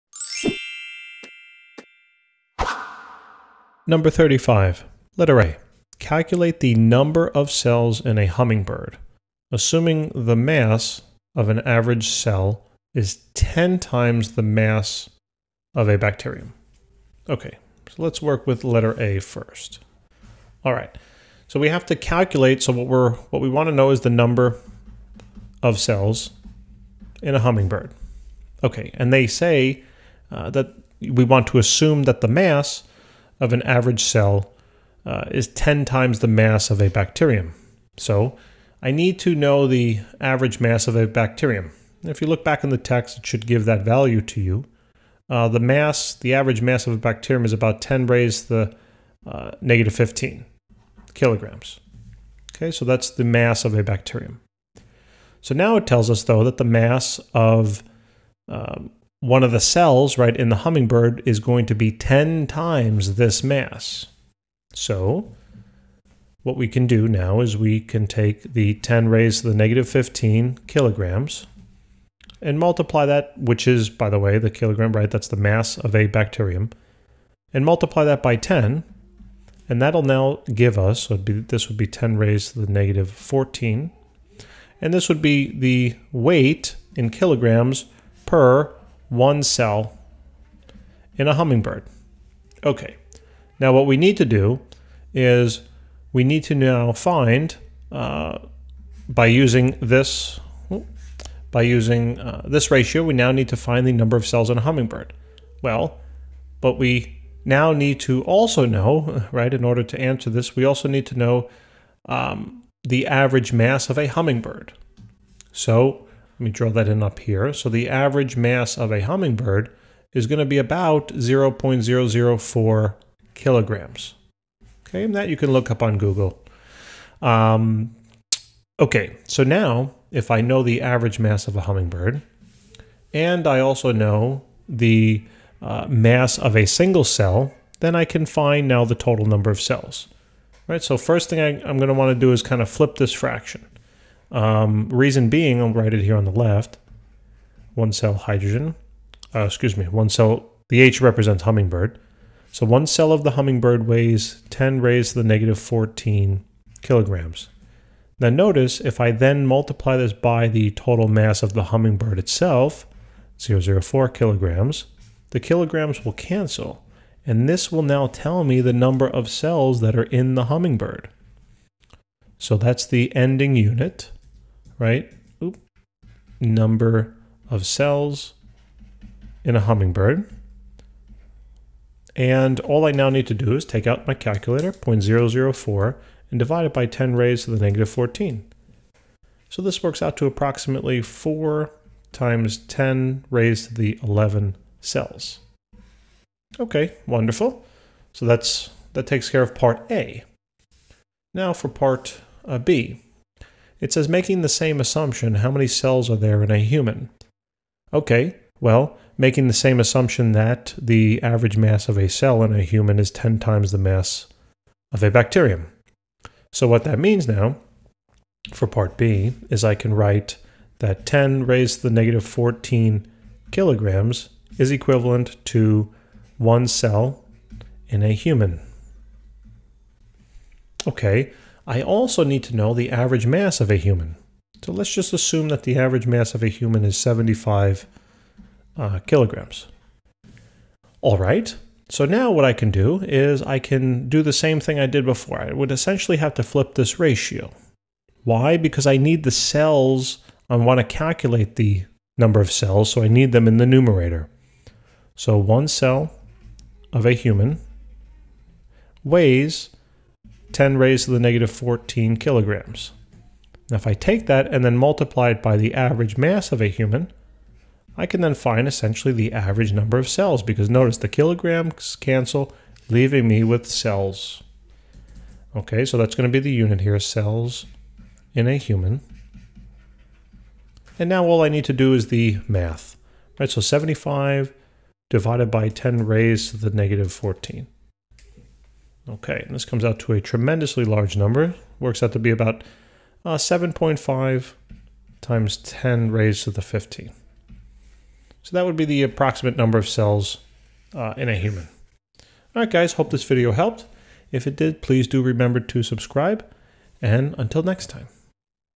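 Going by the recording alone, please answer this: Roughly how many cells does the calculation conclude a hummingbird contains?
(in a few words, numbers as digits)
4 × 10^11.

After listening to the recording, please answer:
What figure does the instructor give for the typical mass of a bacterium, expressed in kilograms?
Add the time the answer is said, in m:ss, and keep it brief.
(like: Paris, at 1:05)
10^-15 kg, at 0:47.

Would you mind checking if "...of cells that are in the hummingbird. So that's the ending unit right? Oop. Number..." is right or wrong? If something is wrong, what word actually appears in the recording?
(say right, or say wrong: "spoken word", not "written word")
right.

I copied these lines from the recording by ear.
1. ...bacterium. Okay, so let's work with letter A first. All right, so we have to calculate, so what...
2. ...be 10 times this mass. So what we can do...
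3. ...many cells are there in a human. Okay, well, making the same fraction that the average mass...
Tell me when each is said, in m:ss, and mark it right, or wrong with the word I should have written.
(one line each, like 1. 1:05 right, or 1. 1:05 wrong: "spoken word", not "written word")
1. 0:15 right
2. 1:01 right
3. 3:25 wrong: "assumption", not "fraction".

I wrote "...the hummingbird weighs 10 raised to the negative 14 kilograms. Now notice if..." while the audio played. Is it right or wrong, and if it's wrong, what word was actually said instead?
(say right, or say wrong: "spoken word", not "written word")
right.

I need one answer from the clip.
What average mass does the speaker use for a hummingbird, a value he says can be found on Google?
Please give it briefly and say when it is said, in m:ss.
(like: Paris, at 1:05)
0.004 kg, at 2:01.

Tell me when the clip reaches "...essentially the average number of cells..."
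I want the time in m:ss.
4:28.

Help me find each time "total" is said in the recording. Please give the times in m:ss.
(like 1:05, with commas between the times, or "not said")
2:18, 2:40.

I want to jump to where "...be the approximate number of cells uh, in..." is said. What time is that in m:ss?
4:58.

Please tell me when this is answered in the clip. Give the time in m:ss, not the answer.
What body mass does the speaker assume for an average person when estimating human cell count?
3:56.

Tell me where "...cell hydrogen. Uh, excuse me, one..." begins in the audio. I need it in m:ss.
2:27.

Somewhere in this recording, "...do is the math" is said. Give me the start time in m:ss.
4:41.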